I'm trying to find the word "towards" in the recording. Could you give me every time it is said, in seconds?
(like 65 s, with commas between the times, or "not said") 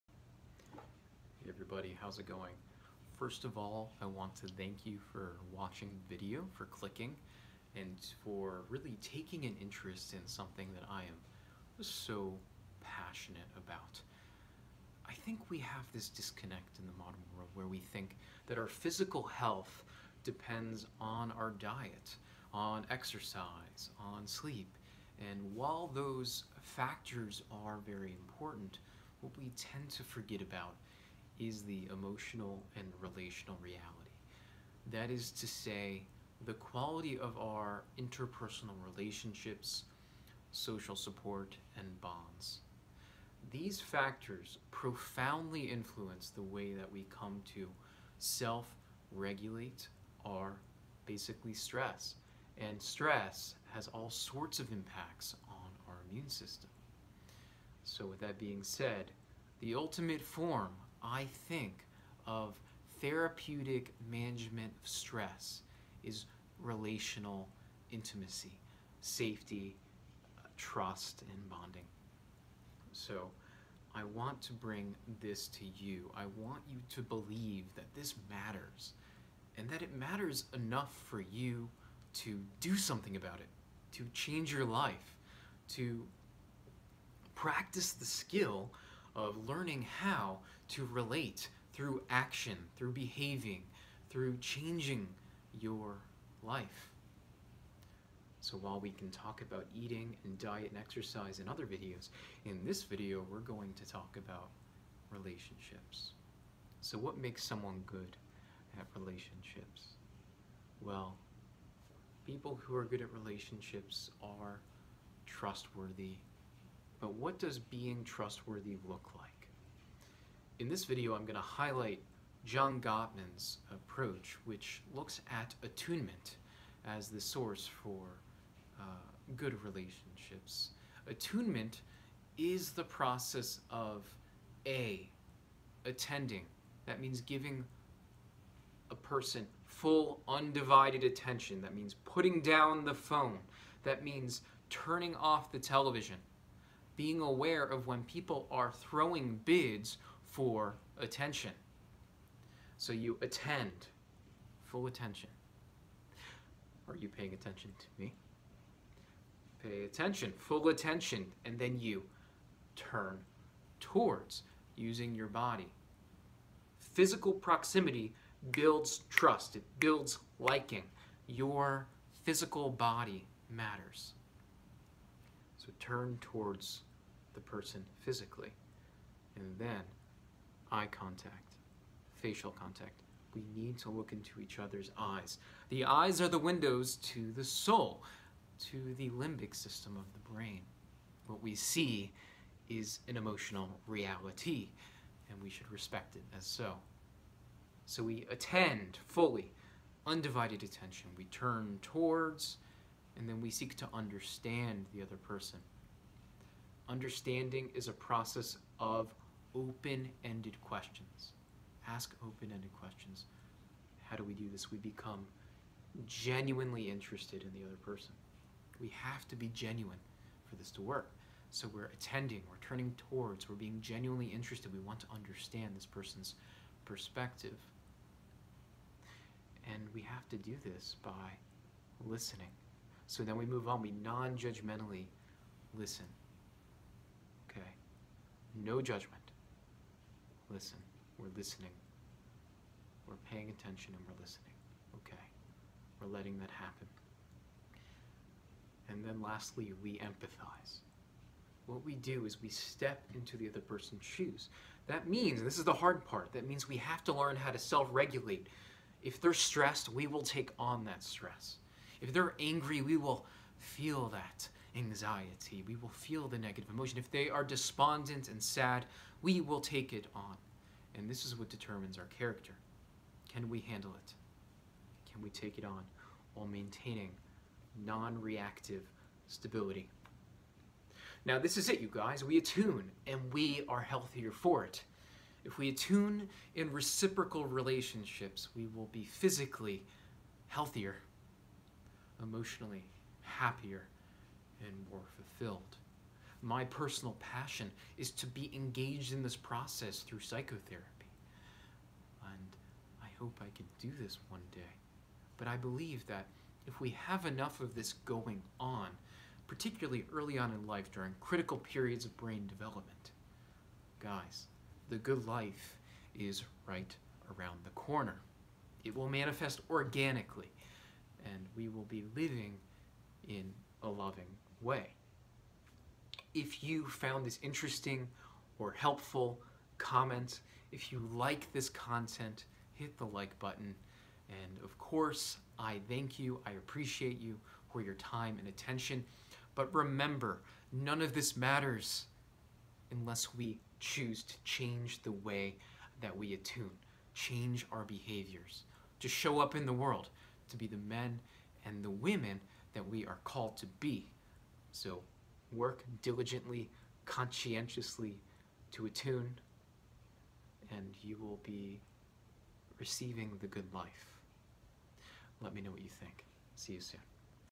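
163 s, 176 s, 201 s, 223 s.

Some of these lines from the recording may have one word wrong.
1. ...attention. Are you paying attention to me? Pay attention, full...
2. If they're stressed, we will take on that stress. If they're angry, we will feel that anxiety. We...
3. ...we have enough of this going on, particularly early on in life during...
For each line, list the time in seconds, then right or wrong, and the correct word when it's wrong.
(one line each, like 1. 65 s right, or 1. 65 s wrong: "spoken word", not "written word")
1. 154 s right
2. 259 s right
3. 306 s right.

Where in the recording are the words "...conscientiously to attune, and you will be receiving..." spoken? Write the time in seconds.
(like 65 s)
357 s.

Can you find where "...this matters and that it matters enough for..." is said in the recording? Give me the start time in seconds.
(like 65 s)
77 s.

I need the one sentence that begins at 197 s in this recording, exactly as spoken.
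So we attend fully, undivided attention.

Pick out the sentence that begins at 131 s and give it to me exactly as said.
Attunement is the process of A, attending.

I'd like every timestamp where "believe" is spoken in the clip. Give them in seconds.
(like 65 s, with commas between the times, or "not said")
77 s, 305 s.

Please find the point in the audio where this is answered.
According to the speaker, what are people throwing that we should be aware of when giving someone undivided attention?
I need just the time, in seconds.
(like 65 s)
149 s.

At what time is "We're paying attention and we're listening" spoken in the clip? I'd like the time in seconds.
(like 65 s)
243 s.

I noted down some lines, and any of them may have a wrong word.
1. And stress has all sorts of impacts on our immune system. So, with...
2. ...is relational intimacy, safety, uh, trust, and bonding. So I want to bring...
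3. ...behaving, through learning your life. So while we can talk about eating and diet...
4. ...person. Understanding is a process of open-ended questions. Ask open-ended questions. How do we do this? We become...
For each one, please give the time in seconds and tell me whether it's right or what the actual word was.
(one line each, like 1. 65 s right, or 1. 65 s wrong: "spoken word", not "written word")
1. 52 s right
2. 66 s right
3. 92 s wrong: "changing", not "learning"
4. 205 s right.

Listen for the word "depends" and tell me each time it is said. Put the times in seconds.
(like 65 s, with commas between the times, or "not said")
20 s.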